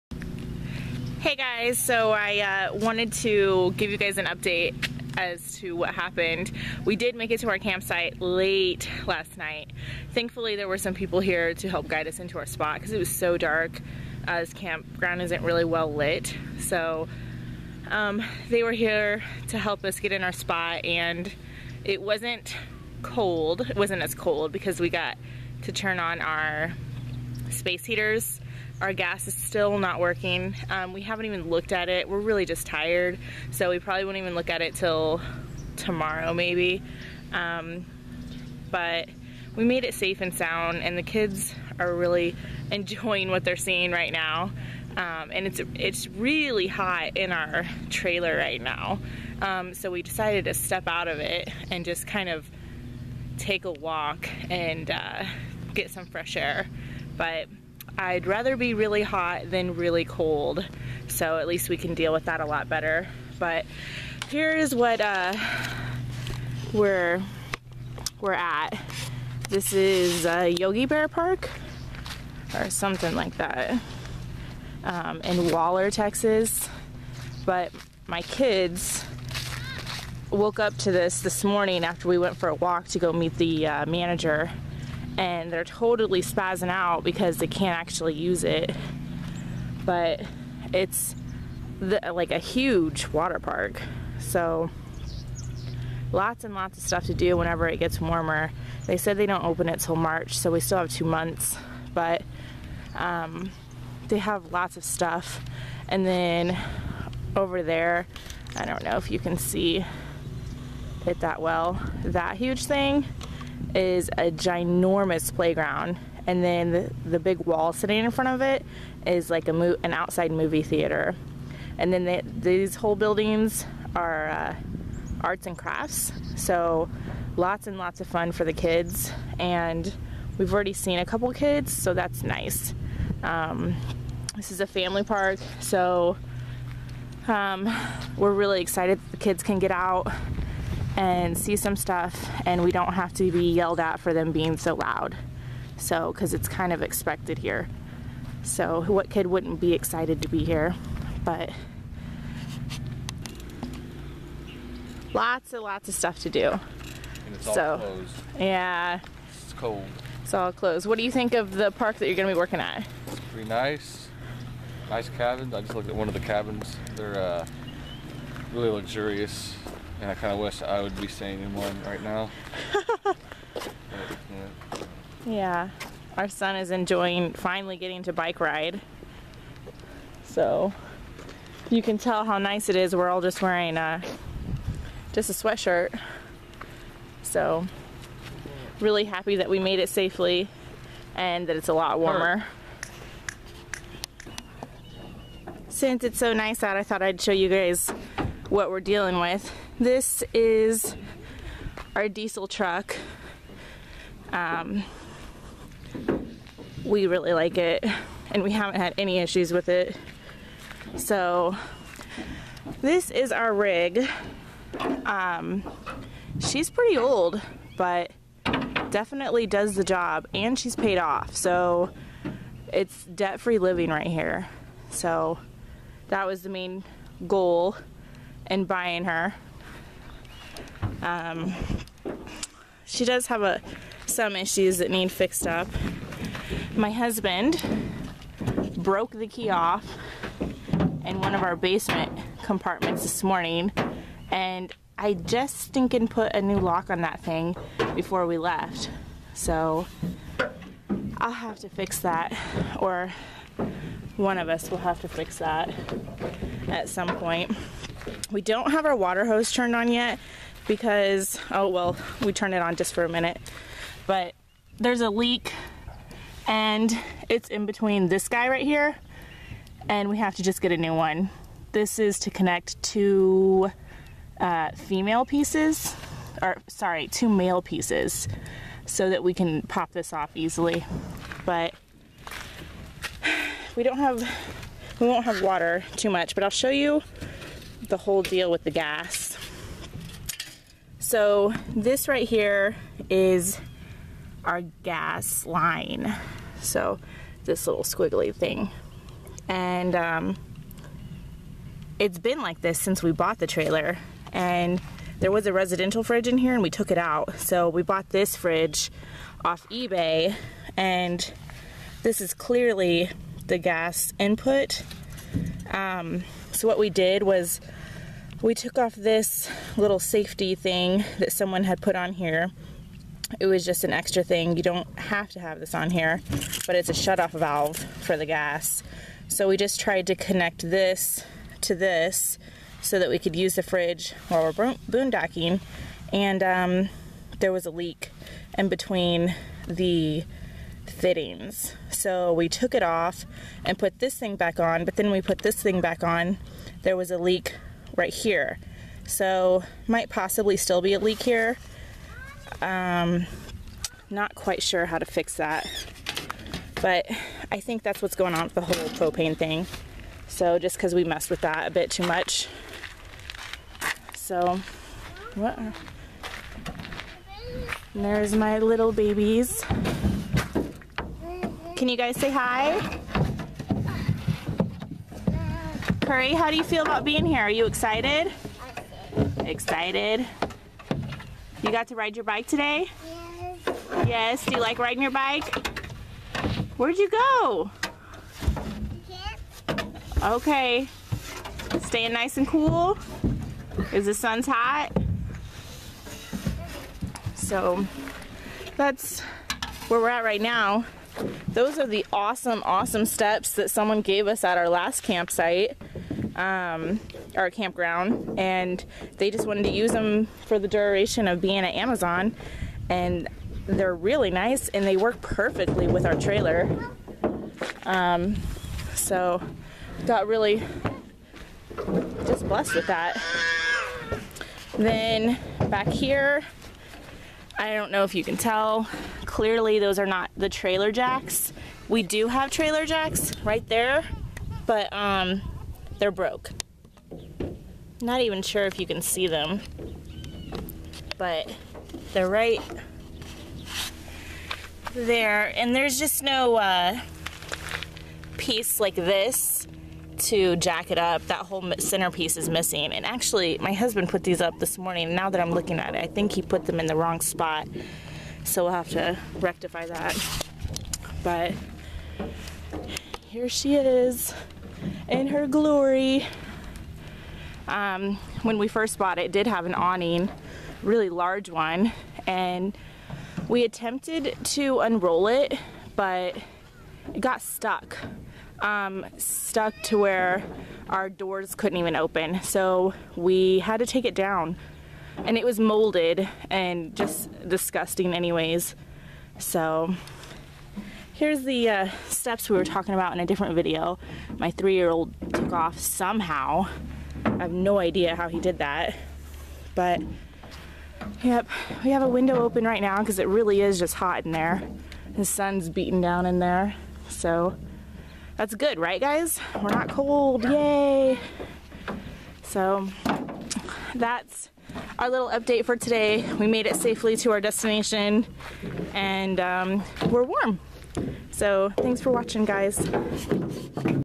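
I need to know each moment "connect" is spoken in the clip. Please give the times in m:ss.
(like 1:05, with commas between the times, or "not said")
4:32, 5:30.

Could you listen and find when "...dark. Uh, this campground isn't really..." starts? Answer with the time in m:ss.
0:13.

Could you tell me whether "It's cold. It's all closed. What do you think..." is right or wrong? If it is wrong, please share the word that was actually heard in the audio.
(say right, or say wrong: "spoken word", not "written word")
right.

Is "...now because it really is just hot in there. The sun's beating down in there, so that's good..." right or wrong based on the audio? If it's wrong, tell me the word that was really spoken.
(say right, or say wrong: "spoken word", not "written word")
right.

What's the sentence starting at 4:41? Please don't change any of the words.
But we don't have, we won't have water too much, but I'll show you the whole deal with the gas.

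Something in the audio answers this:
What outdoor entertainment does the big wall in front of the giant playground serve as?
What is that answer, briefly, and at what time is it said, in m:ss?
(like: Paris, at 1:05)
outside movie theater, at 1:59.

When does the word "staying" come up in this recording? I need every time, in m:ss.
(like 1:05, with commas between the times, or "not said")
2:51, 6:31.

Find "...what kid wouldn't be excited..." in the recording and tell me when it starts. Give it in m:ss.
2:28.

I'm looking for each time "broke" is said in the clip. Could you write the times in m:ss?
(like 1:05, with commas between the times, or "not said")
3:58, 7:16.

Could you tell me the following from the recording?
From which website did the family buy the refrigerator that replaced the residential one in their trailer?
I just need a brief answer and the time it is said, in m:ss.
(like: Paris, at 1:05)
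eBay, at 5:09.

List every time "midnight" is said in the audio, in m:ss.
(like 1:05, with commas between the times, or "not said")
not said.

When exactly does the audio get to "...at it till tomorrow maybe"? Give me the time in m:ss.
0:34.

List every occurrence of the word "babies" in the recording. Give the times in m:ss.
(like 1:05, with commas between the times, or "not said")
6:08.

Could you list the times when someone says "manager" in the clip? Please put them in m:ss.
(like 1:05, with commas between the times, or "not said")
1:23.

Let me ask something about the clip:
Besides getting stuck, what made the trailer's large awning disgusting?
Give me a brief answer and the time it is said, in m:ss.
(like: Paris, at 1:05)
molded, at 8:05.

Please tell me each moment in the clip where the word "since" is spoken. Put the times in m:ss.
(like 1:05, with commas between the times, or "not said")
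3:15, 5:02.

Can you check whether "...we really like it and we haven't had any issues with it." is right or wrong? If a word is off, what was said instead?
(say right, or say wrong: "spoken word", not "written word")
right.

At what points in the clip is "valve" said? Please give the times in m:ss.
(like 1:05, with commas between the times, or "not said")
5:27.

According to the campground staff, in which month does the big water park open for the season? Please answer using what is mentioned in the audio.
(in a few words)
March.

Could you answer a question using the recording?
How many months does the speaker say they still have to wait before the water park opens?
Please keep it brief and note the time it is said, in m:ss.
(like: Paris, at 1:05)
2, at 1:40.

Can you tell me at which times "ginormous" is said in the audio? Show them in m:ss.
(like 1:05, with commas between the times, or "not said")
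1:54.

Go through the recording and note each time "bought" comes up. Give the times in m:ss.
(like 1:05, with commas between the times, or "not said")
5:03, 5:07, 7:48.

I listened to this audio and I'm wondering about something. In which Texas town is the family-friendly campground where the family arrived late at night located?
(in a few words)
Waller.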